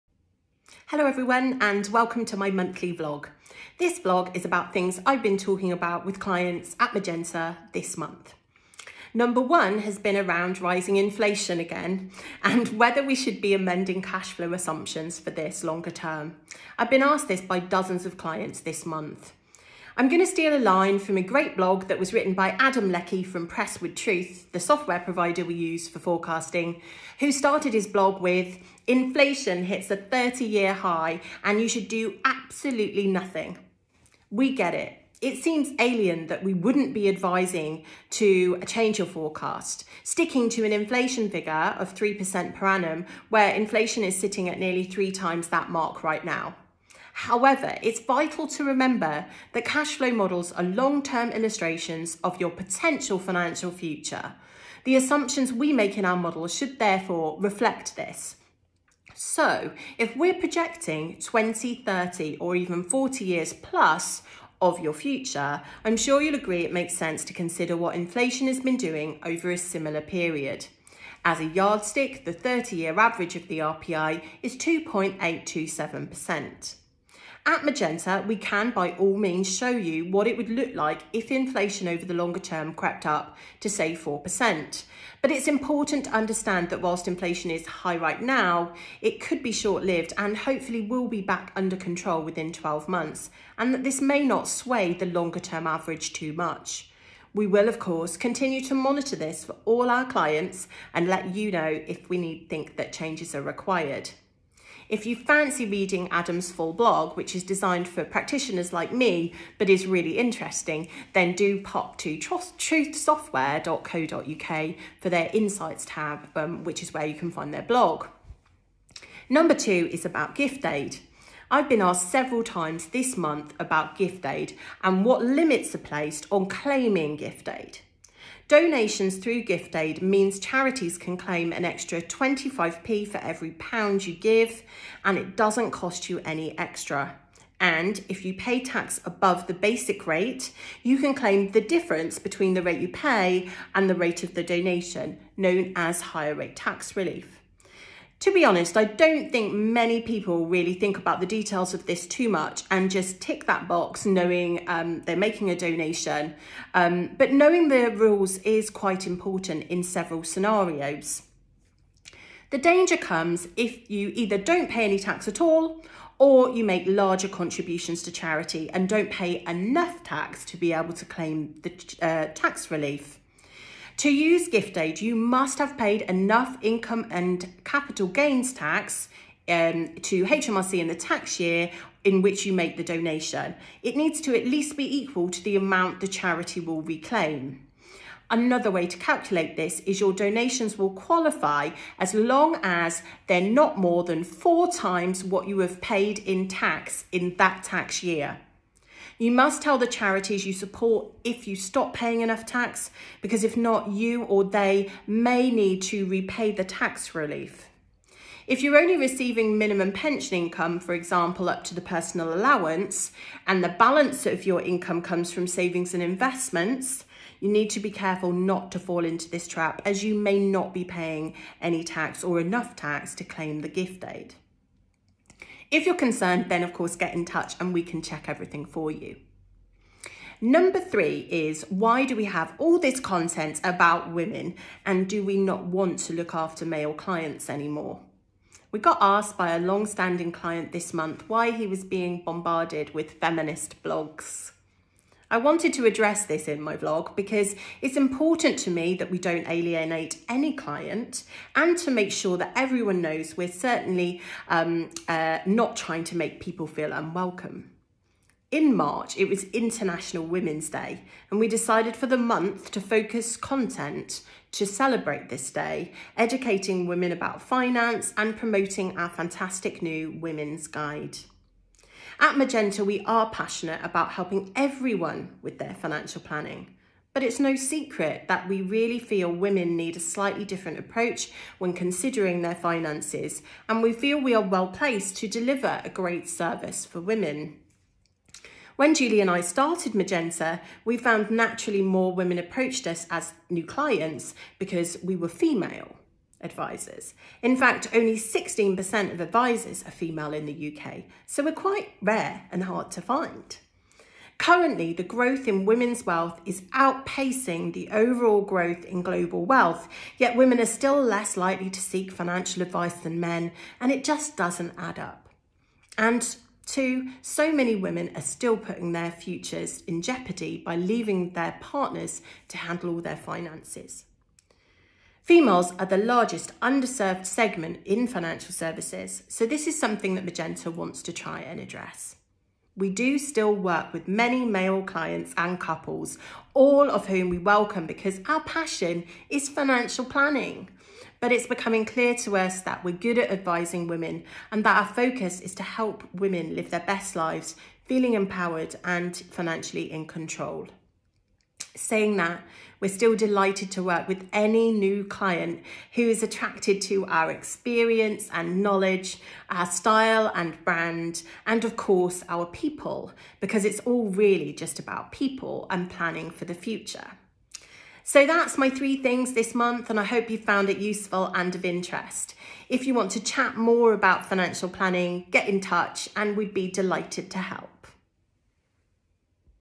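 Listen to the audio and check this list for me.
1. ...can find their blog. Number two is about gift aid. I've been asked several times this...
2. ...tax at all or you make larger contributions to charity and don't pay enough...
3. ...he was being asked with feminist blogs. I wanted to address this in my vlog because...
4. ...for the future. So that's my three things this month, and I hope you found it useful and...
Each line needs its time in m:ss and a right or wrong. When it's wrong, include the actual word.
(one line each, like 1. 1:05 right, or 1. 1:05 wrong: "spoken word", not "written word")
1. 1:57 right
2. 2:44 right
3. 4:01 wrong: "bombarded", not "asked"
4. 6:06 right.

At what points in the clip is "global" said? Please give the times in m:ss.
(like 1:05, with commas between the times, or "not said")
5:09.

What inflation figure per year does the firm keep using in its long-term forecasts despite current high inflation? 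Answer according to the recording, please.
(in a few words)
3%.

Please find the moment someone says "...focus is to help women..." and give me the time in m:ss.
5:44.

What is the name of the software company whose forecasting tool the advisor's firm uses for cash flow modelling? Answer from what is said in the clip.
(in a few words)
Prestwood Truth.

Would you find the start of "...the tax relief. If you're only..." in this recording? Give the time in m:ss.
3:26.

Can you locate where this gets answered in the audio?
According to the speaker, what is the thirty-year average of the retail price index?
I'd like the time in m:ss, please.
1:14.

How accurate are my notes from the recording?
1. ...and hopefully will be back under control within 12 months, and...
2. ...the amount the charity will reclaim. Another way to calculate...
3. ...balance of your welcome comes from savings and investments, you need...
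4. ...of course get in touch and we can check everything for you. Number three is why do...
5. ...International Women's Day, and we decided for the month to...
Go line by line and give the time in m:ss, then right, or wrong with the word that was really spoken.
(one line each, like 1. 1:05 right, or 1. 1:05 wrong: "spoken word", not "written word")
1. 1:30 right
2. 3:05 right
3. 3:33 wrong: "income", not "welcome"
4. 3:46 right
5. 4:19 right.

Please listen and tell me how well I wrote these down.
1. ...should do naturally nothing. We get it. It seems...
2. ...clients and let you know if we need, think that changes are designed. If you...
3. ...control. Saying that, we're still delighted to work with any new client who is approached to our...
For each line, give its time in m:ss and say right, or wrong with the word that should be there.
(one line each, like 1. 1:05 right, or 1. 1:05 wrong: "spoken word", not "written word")
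1. 0:31 wrong: "absolutely", not "naturally"
2. 1:40 wrong: "required", not "designed"
3. 5:50 wrong: "attracted", not "approached".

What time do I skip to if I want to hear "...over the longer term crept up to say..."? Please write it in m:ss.
1:21.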